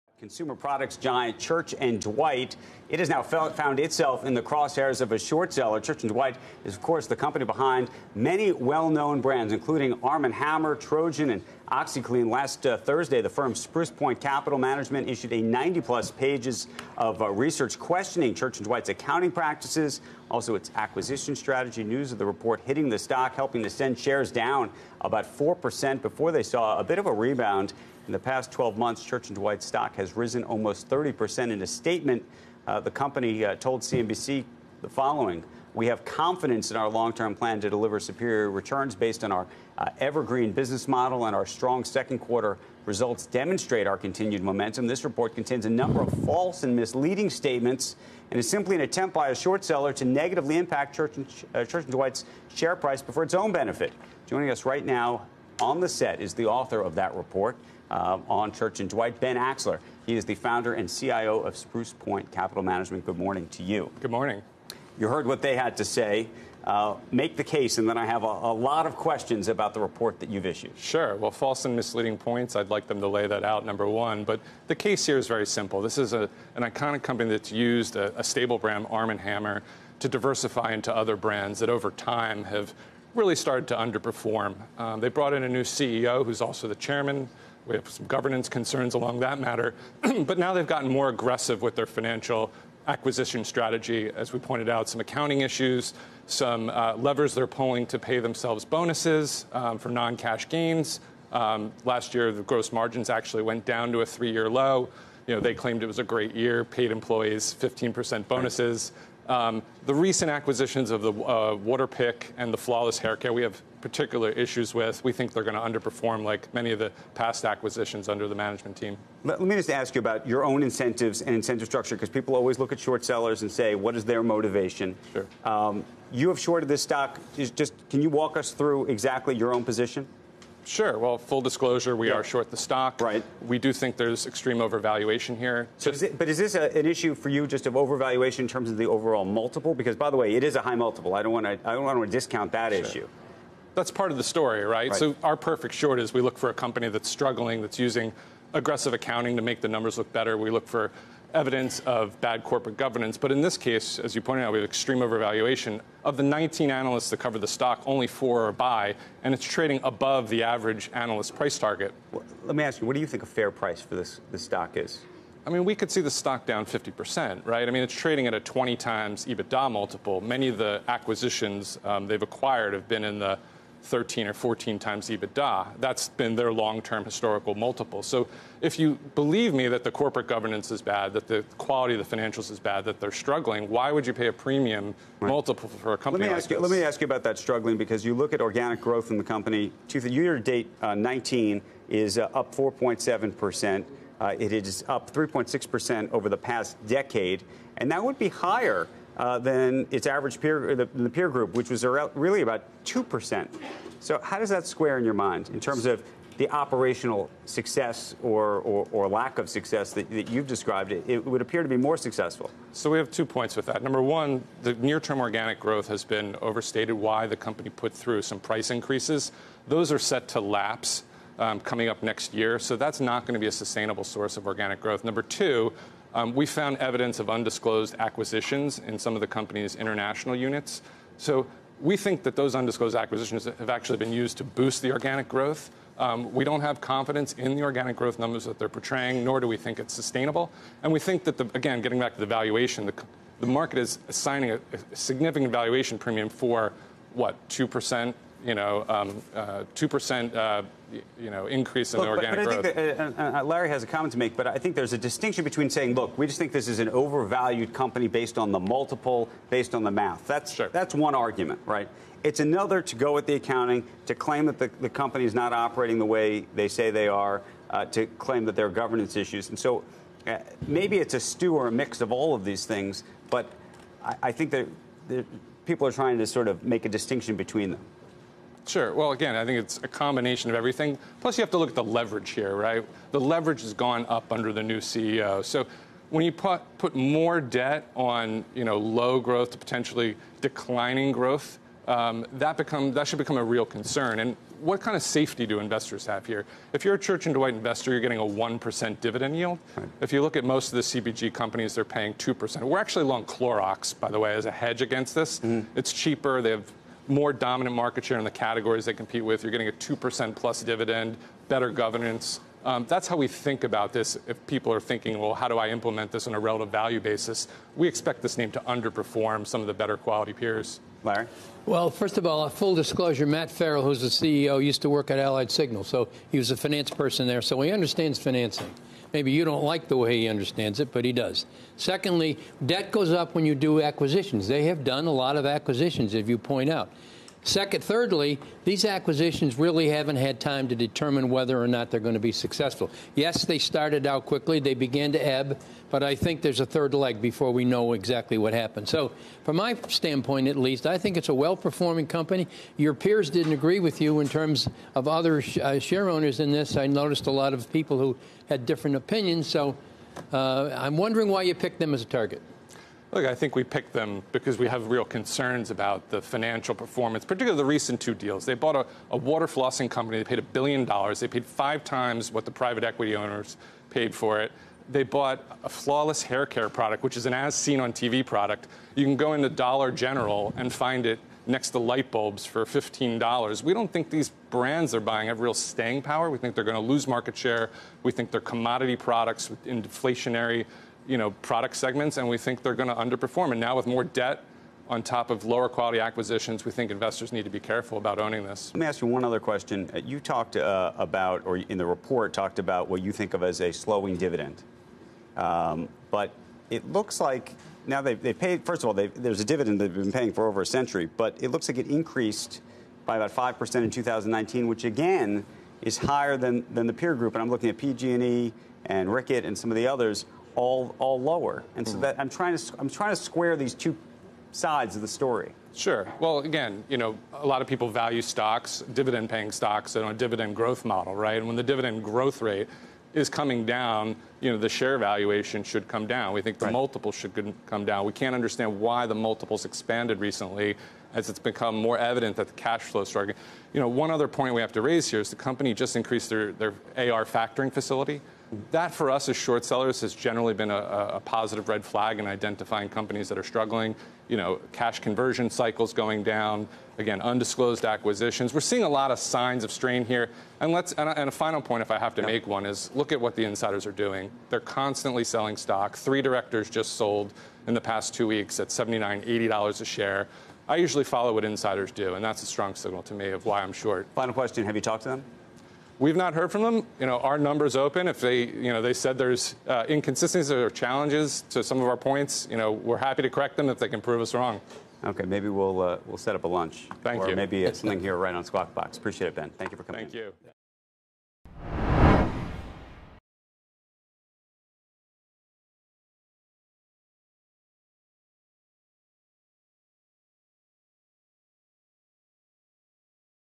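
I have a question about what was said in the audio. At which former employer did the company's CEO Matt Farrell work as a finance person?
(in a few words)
Allied Signal.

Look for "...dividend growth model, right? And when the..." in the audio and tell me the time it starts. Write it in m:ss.
7:10.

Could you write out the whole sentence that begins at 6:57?
And I'm looking at PG&E and Reckitt and some of the others all all lower.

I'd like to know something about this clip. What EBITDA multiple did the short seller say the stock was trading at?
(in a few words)
20 times.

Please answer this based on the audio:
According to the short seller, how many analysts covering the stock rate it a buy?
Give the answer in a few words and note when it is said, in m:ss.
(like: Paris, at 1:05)
4, at 2:37.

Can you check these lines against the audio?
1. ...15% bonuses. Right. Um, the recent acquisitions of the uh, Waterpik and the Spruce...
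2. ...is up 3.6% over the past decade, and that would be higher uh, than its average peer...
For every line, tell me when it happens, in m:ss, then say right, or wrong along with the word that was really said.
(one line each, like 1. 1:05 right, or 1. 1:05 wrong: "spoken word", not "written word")
1. 1:47 wrong: "Flawless", not "Spruce"
2. 3:14 right.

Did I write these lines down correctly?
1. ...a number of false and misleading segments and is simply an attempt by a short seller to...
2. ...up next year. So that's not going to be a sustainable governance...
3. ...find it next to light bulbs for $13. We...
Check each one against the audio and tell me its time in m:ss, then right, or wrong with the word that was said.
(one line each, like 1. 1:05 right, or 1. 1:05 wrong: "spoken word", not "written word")
1. 0:45 wrong: "statements", not "segments"
2. 3:41 wrong: "source", not "governance"
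3. 6:20 wrong: "15", not "13".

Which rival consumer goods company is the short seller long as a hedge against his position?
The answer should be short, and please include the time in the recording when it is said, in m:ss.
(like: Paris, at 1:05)
Clorox, at 5:03.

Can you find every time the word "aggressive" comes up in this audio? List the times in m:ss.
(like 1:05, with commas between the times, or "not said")
1:31, 2:28.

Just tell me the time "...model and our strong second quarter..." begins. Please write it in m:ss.
0:40.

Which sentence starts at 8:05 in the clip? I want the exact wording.
Okay, maybe we'll uh, we'll set up a lunch.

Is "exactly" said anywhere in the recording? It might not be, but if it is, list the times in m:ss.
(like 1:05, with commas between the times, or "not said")
2:08, 5:47.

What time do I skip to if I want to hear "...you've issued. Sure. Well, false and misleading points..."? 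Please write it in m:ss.
1:10.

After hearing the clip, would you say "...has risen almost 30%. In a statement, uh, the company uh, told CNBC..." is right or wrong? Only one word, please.
right.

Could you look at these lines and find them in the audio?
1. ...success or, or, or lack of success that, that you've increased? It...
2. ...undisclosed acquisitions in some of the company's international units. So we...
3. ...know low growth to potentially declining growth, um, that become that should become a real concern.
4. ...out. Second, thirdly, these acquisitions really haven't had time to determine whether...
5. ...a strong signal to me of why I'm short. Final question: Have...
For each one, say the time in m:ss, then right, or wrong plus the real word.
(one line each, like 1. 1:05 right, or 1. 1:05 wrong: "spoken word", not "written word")
1. 3:27 wrong: "described", not "increased"
2. 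3:47 right
3. 4:48 right
4. 5:36 right
5. 7:52 right.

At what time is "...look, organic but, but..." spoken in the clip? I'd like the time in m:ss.
4:12.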